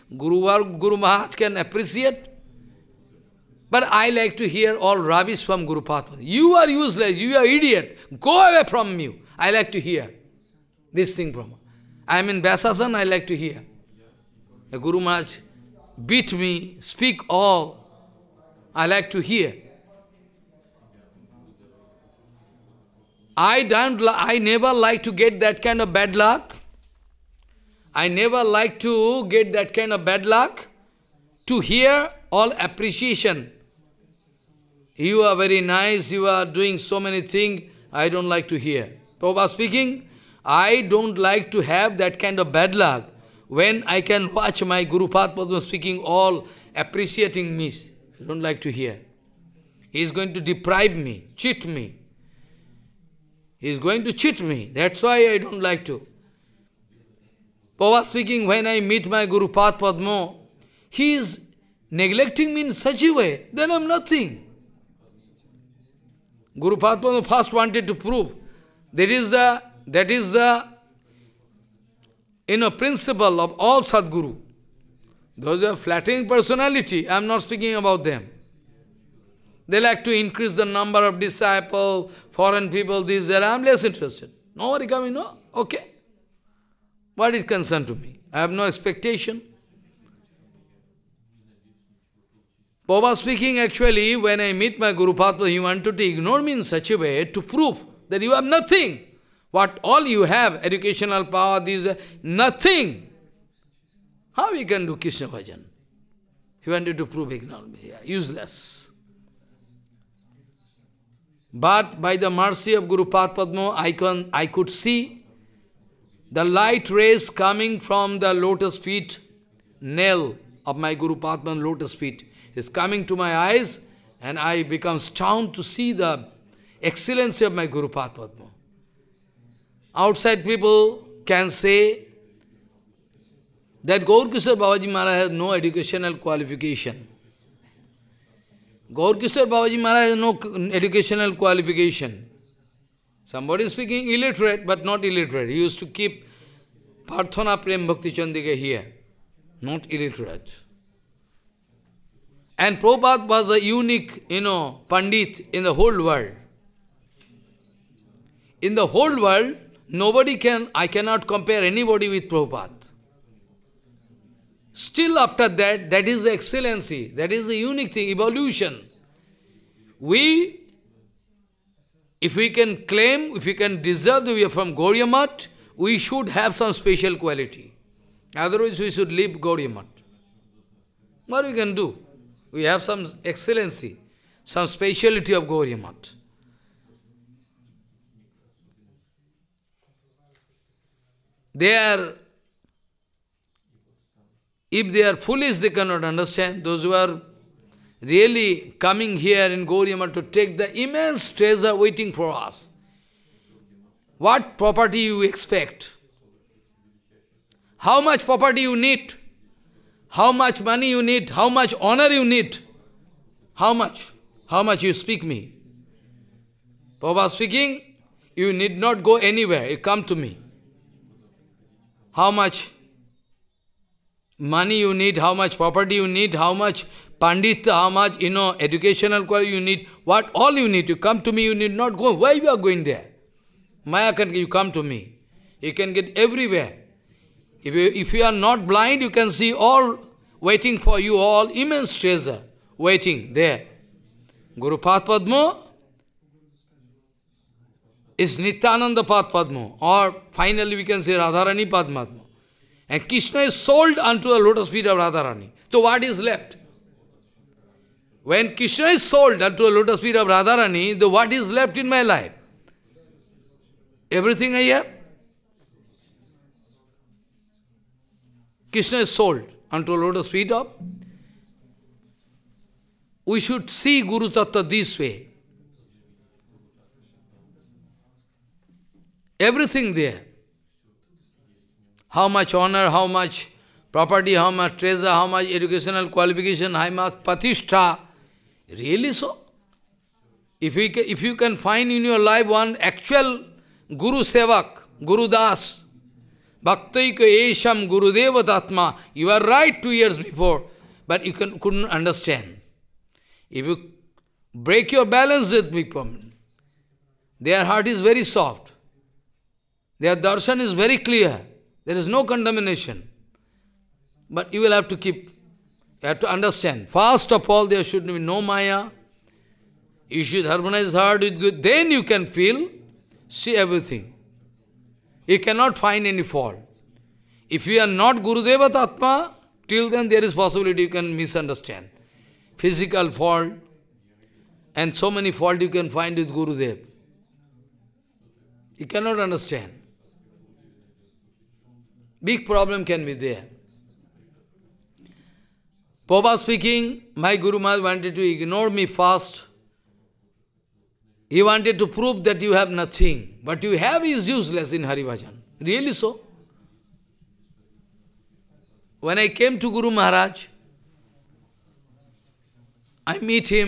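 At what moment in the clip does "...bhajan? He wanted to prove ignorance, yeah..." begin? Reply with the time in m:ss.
1:45.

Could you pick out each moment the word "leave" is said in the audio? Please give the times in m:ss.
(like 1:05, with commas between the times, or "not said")
2:59.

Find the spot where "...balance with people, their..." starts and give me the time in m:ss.
5:05.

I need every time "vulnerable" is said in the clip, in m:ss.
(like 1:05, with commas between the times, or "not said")
not said.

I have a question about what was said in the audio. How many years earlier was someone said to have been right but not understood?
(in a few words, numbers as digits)
2.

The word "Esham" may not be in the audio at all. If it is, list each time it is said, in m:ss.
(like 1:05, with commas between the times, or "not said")
4:57.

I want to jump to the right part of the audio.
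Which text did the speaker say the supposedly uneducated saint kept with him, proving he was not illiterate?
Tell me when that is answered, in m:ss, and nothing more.
2:27.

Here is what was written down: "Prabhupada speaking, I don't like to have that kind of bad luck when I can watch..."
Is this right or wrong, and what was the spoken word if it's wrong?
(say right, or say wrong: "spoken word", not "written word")
right.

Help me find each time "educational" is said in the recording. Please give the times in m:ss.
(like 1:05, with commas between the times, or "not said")
1:40, 2:15, 2:20, 3:48, 4:45.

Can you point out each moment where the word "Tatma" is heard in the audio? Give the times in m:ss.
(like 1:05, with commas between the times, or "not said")
4:58, 5:28.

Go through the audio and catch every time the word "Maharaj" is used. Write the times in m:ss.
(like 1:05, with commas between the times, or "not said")
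0:00, 0:15, 2:14, 2:19, 5:47, 5:59.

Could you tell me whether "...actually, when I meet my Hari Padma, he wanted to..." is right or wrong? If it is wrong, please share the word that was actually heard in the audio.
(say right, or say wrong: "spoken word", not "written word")
wrong: "Guru", not "Hari".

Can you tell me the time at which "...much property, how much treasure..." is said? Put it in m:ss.
4:43.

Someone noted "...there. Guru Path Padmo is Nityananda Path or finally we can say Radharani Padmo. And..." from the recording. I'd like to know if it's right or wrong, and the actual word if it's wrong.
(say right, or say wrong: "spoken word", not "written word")
right.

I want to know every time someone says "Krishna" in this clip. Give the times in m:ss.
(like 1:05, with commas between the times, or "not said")
1:44, 4:13, 4:18, 4:28.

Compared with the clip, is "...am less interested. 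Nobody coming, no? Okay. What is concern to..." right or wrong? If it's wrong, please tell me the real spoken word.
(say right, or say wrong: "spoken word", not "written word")
right.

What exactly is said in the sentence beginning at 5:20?
You should harmonize heart with good.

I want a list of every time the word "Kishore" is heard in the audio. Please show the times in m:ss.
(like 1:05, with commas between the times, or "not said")
2:14, 2:19.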